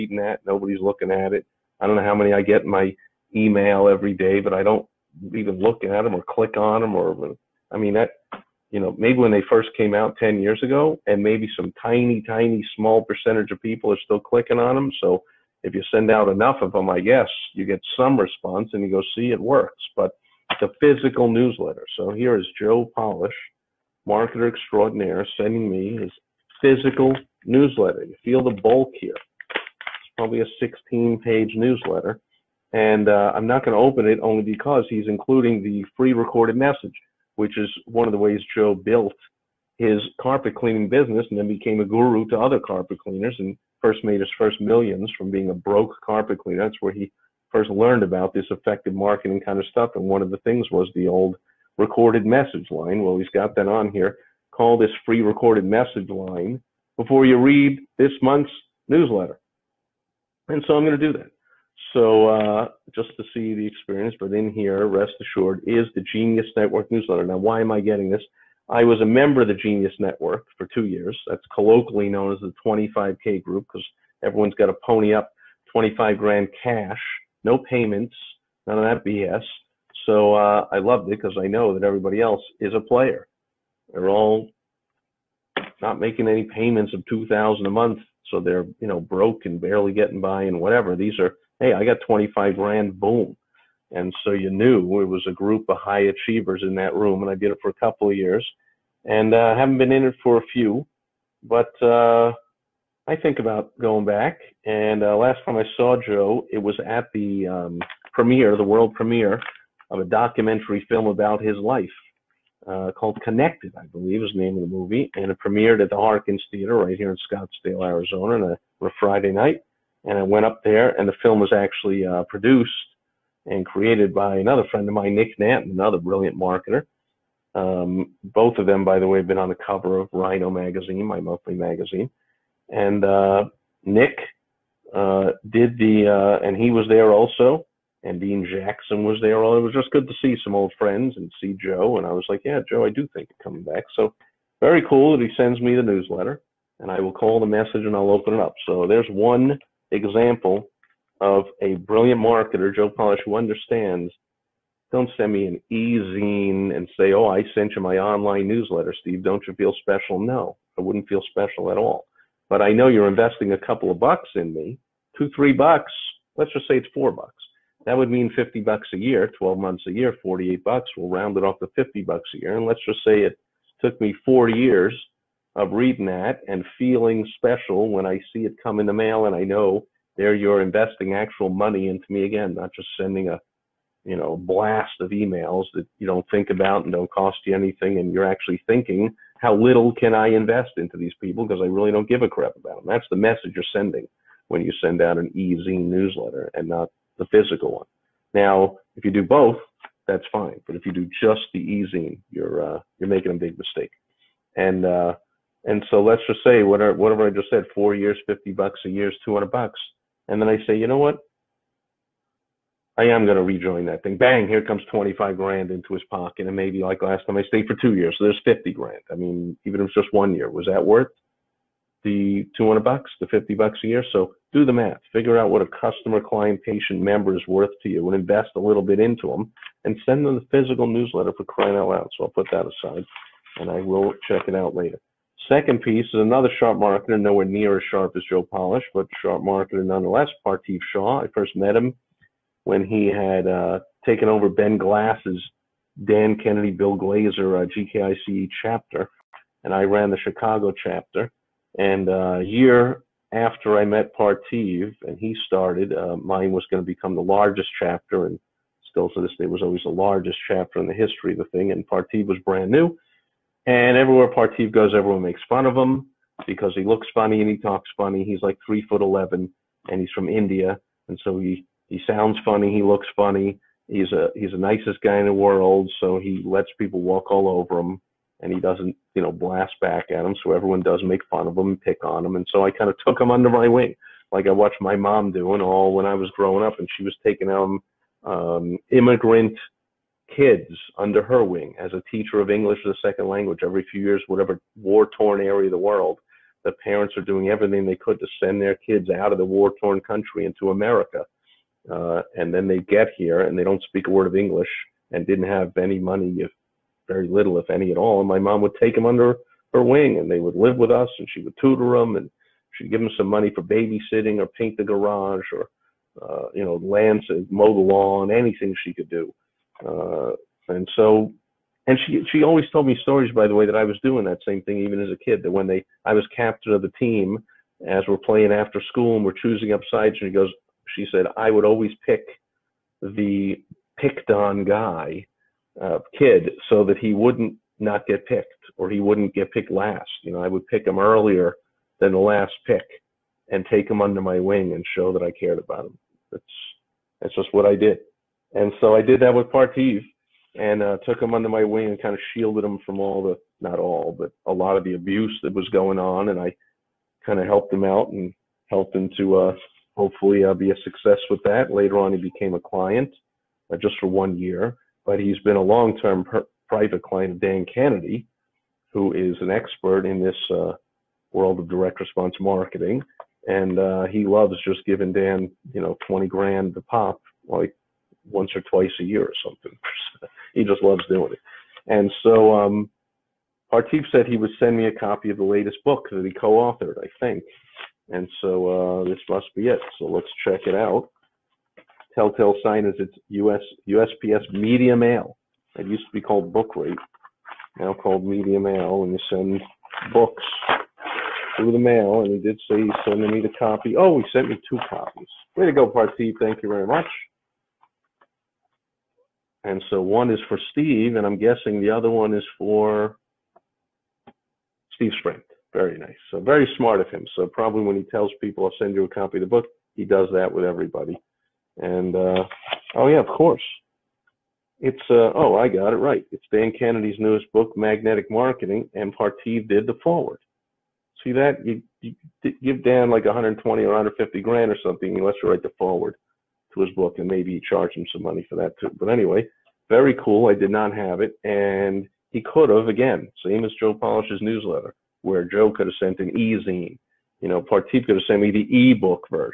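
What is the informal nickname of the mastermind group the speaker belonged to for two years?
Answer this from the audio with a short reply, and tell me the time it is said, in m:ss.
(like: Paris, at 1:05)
The 25K group, at 1:12.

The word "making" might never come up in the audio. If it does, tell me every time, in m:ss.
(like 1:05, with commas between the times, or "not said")
1:25, 3:23.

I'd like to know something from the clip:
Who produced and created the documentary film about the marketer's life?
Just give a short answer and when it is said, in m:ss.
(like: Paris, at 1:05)
Nick Nanton, at 2:05.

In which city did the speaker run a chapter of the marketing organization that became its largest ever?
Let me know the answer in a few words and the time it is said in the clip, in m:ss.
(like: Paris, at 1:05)
Chicago, at 4:10.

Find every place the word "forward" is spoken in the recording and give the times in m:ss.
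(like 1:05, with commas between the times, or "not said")
7:10, 7:15.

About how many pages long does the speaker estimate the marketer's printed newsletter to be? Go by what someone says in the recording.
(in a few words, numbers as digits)
16.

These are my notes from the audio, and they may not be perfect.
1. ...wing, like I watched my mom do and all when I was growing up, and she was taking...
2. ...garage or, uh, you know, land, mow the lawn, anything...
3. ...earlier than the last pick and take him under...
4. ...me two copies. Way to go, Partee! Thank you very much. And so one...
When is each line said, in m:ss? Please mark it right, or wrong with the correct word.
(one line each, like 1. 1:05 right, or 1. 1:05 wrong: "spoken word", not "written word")
1. 4:43 right
2. 5:14 right
3. 5:40 right
4. 6:44 right.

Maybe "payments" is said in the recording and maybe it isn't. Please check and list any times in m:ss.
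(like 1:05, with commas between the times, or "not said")
1:17, 1:26.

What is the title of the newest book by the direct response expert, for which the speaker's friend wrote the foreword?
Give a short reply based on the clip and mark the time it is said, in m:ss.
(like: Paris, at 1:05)
Magnetic Marketing, at 7:07.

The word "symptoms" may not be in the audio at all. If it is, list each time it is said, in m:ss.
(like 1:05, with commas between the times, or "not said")
not said.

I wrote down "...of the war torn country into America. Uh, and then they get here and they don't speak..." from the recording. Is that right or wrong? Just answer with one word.
right.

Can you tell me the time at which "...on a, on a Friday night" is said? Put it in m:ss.
1:58.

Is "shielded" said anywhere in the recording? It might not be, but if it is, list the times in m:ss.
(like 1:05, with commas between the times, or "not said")
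5:52.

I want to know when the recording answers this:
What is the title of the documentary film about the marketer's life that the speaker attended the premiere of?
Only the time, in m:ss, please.
1:53.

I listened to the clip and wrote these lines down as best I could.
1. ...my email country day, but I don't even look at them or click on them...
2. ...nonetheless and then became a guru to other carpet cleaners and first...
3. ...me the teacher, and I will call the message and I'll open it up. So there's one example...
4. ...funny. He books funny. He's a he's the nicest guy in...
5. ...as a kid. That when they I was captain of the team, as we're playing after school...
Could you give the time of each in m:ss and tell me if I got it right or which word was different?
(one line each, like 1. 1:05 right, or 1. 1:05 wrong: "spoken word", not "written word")
1. 0:02 wrong: "every", not "country"
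2. 0:40 wrong: "business", not "nonetheless"
3. 2:25 wrong: "newsletter", not "teacher"
4. 4:32 wrong: "looks", not "books"
5. 5:25 right.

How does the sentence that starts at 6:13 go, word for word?
And uh, he loves just giving Dan, you know, 20 grand to pop, like once or twice a year or something.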